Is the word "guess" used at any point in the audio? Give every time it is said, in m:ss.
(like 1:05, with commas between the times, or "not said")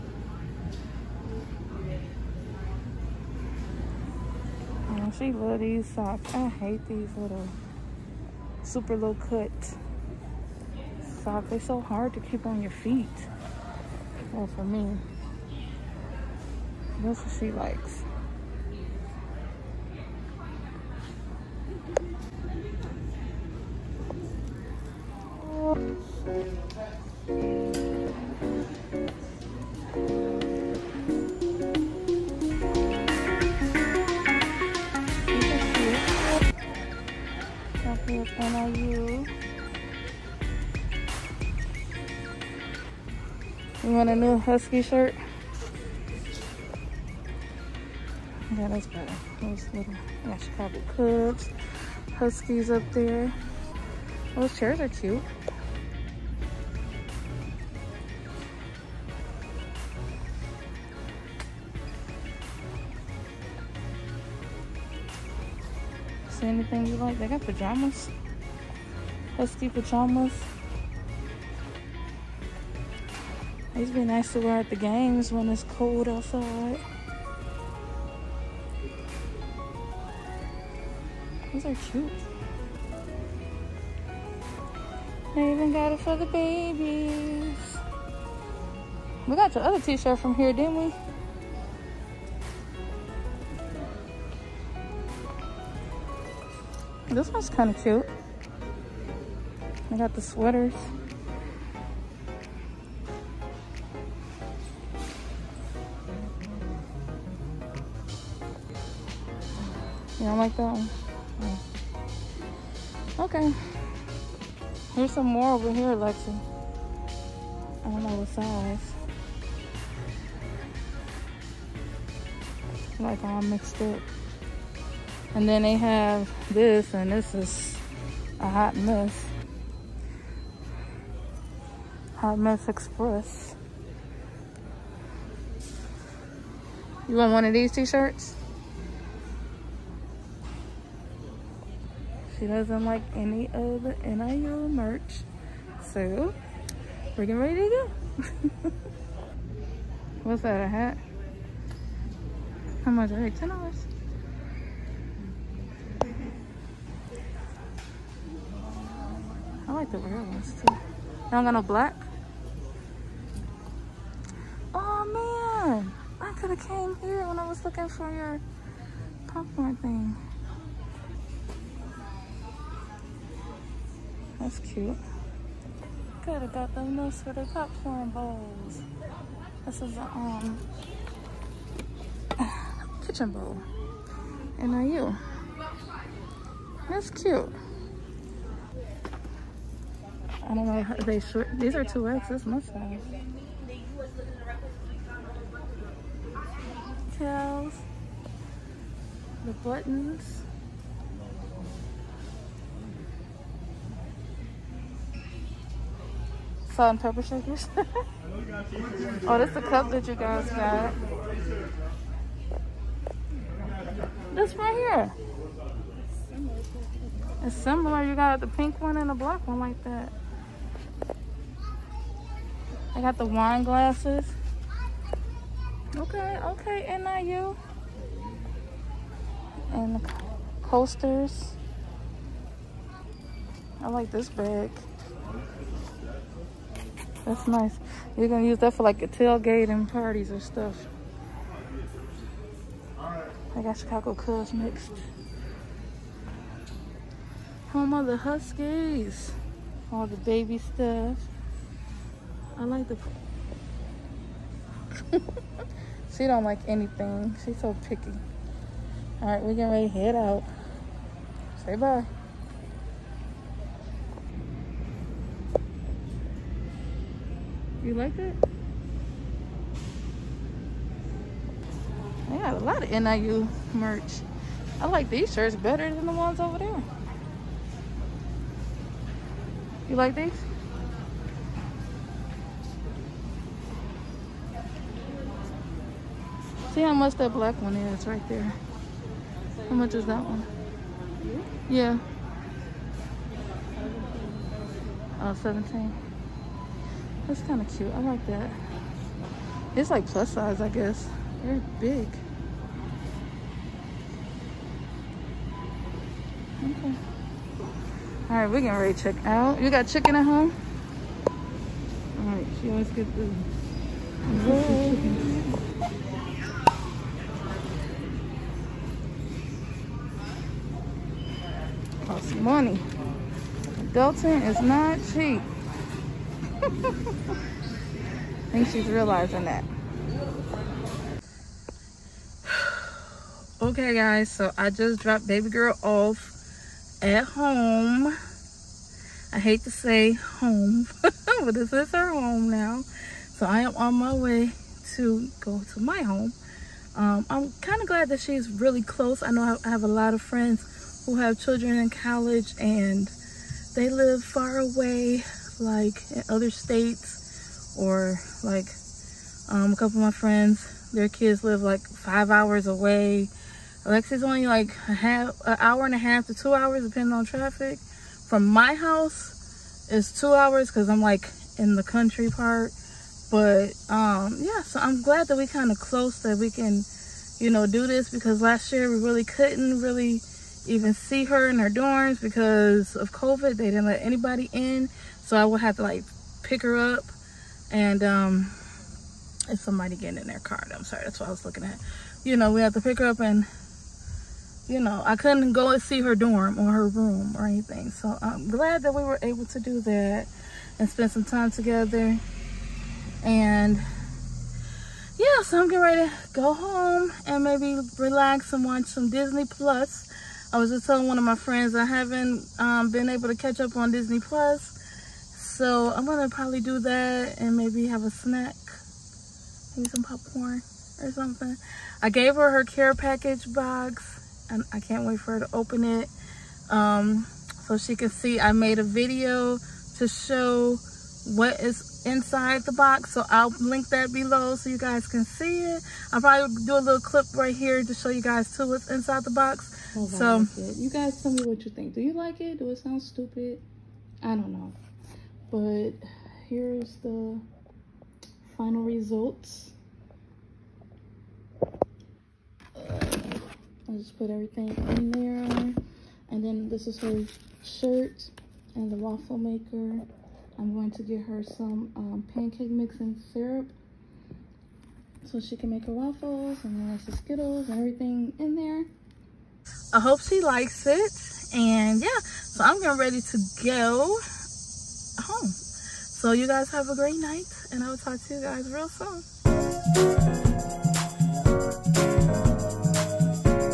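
5:00.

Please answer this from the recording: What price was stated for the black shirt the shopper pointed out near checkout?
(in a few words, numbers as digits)
$17.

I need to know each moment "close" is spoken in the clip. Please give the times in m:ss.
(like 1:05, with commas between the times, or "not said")
5:48, 6:15.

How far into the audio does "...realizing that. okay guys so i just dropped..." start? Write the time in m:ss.
5:28.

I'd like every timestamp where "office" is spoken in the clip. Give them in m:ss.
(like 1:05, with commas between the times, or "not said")
not said.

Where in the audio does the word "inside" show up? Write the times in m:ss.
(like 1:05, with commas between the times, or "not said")
7:12, 7:18.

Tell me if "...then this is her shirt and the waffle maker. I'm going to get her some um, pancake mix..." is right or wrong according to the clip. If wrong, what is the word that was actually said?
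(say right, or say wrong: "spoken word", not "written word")
right.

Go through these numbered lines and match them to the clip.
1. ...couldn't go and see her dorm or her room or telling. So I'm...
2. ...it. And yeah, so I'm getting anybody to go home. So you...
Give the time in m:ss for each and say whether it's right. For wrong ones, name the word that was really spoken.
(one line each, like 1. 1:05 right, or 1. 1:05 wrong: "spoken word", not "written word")
1. 6:35 wrong: "anything", not "telling"
2. 7:50 wrong: "ready", not "anybody".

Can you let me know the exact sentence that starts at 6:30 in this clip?
I'm sorry, that's what I was looking at.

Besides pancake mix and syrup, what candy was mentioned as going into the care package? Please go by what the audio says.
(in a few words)
Skittles.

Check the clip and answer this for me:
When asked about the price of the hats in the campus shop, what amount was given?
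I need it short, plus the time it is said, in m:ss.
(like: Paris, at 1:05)
$10, at 2:33.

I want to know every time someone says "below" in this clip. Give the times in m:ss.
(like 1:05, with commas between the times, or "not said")
7:14.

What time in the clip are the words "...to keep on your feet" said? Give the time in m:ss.
0:12.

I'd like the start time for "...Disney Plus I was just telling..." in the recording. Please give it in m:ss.
6:49.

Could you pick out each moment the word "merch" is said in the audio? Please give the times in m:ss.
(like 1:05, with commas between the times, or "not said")
2:24, 4:33.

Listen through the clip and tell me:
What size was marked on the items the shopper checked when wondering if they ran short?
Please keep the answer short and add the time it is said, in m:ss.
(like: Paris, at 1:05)
2X, at 3:11.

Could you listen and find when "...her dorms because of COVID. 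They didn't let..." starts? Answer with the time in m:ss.
6:21.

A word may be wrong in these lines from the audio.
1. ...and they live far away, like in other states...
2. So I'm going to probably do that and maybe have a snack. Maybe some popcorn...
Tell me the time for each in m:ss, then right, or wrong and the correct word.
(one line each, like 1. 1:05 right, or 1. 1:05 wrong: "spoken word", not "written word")
1. 5:52 right
2. 6:55 right.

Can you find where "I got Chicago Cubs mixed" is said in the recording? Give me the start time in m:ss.
4:03.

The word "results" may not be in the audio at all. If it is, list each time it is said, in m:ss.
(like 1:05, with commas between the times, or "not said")
7:28.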